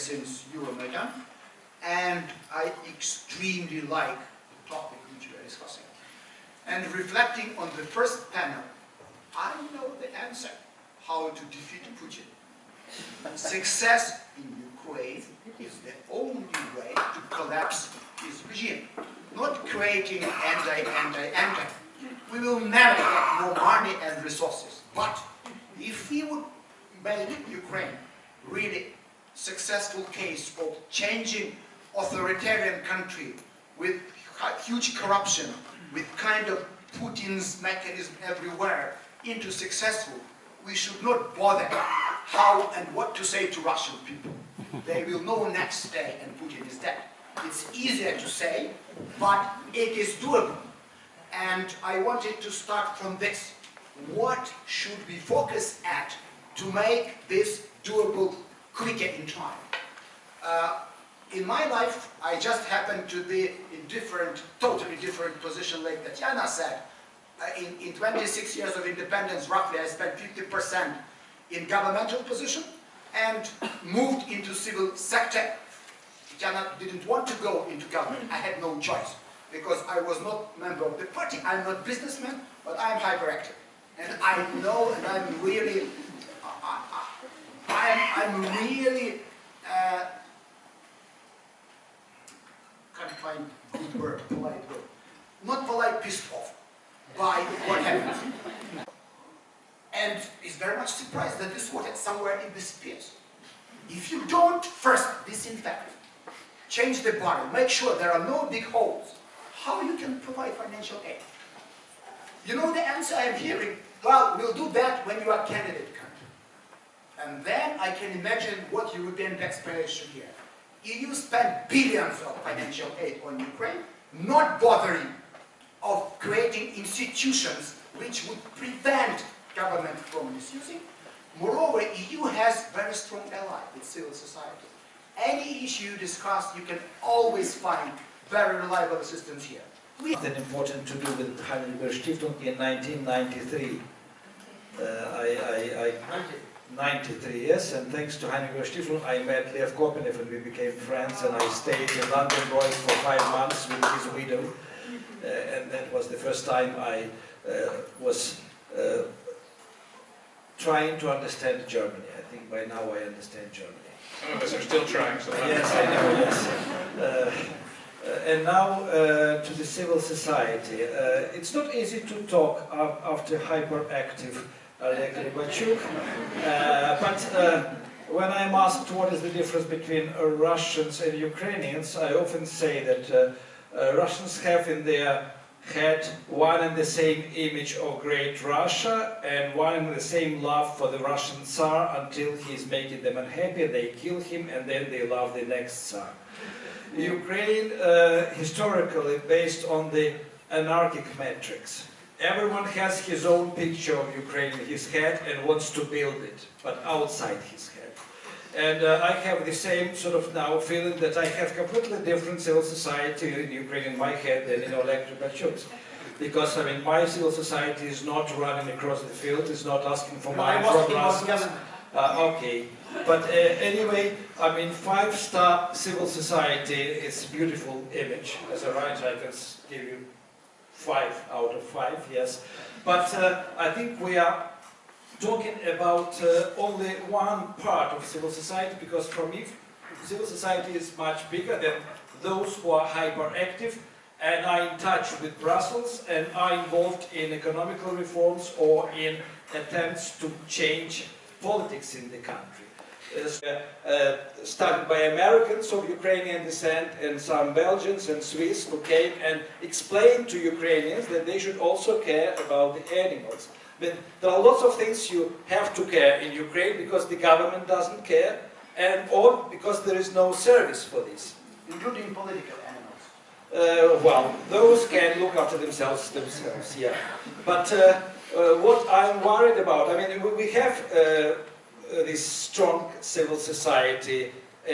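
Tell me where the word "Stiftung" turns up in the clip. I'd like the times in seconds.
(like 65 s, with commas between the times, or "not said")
141 s, 148 s.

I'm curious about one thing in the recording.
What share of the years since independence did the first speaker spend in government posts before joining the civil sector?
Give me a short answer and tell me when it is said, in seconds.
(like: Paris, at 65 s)
50%, at 70 s.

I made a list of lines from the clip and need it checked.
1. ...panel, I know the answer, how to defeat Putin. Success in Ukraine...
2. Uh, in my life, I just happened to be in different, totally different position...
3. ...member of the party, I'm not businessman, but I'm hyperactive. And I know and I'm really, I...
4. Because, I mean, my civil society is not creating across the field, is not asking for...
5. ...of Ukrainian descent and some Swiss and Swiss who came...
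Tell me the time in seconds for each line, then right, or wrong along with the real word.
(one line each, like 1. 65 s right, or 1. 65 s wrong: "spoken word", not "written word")
1. 8 s right
2. 60 s right
3. 80 s right
4. 216 s wrong: "running", not "creating"
5. 255 s wrong: "Belgians", not "Swiss".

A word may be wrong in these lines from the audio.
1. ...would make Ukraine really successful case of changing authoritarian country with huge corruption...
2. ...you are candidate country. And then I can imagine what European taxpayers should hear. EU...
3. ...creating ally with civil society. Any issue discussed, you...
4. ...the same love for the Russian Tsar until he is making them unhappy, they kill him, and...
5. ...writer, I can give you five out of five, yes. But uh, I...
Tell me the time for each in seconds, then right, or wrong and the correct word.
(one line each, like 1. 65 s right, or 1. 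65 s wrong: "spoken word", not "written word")
1. 26 s right
2. 115 s right
3. 132 s wrong: "strong", not "creating"
4. 189 s right
5. 228 s right.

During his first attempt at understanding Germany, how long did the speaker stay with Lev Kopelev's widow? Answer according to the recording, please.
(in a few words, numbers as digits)
5 months.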